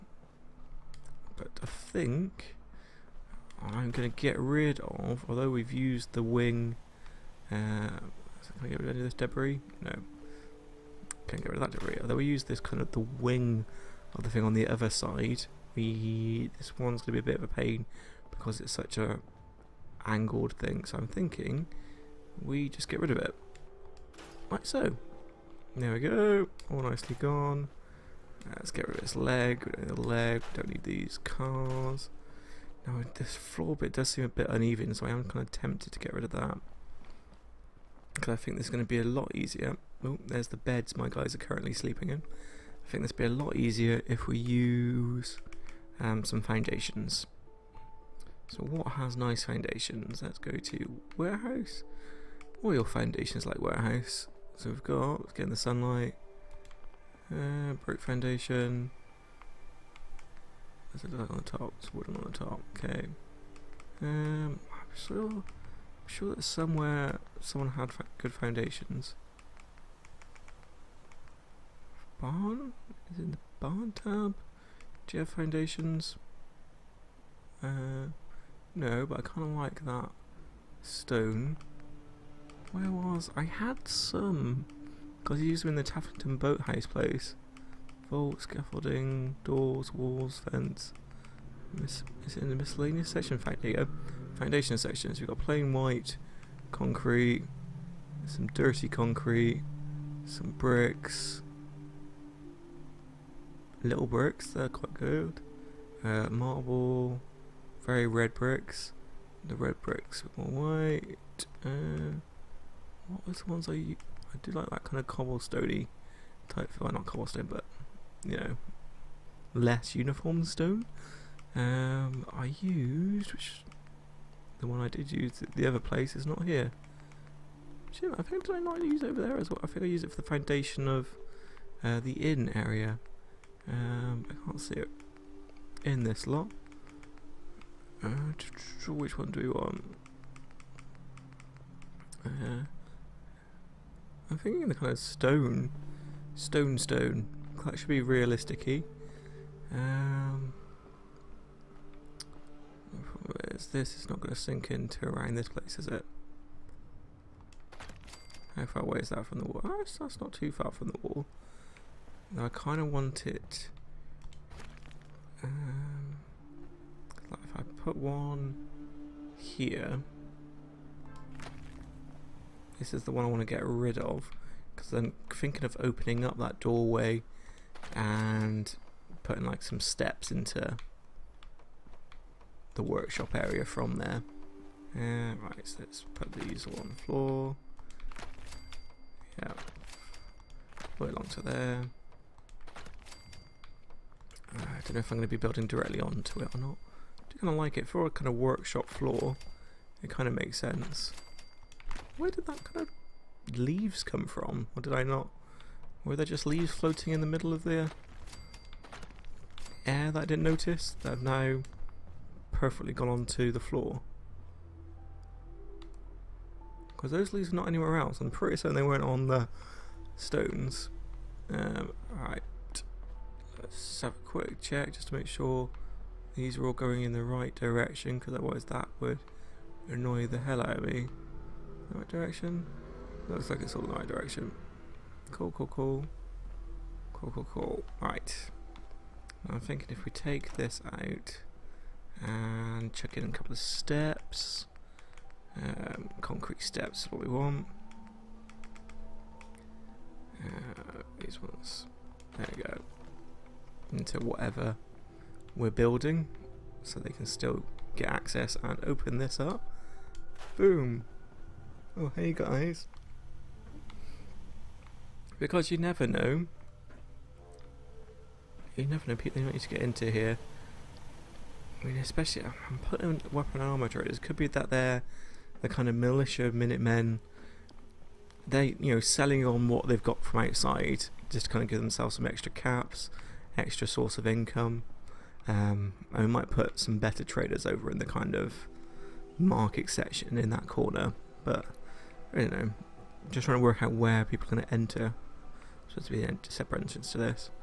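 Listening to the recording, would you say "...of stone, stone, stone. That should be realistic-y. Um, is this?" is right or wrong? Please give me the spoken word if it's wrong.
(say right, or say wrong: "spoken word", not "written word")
right.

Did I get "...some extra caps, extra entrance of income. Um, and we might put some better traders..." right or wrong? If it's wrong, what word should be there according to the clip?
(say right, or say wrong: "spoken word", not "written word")
wrong: "source", not "entrance".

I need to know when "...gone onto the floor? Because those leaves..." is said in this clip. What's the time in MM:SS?
03:32.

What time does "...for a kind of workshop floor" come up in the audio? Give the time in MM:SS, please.
03:17.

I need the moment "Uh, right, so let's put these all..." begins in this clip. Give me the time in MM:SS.
03:04.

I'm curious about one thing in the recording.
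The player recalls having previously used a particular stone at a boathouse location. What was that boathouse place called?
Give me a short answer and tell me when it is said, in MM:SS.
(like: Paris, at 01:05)
Taffington, at 01:25.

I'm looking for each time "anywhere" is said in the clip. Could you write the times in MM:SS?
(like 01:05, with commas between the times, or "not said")
03:37.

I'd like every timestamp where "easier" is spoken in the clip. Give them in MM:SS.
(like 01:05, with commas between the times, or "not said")
00:39, 00:43.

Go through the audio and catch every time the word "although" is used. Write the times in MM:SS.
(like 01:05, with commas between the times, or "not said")
00:05, 00:12.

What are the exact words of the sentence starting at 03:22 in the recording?
Where did that kind of leaves come from?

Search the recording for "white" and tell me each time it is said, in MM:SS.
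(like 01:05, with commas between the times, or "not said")
01:35, 01:50.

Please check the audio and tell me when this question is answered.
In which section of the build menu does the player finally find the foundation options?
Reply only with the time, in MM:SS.
01:32.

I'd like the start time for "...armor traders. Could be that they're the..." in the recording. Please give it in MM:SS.
04:33.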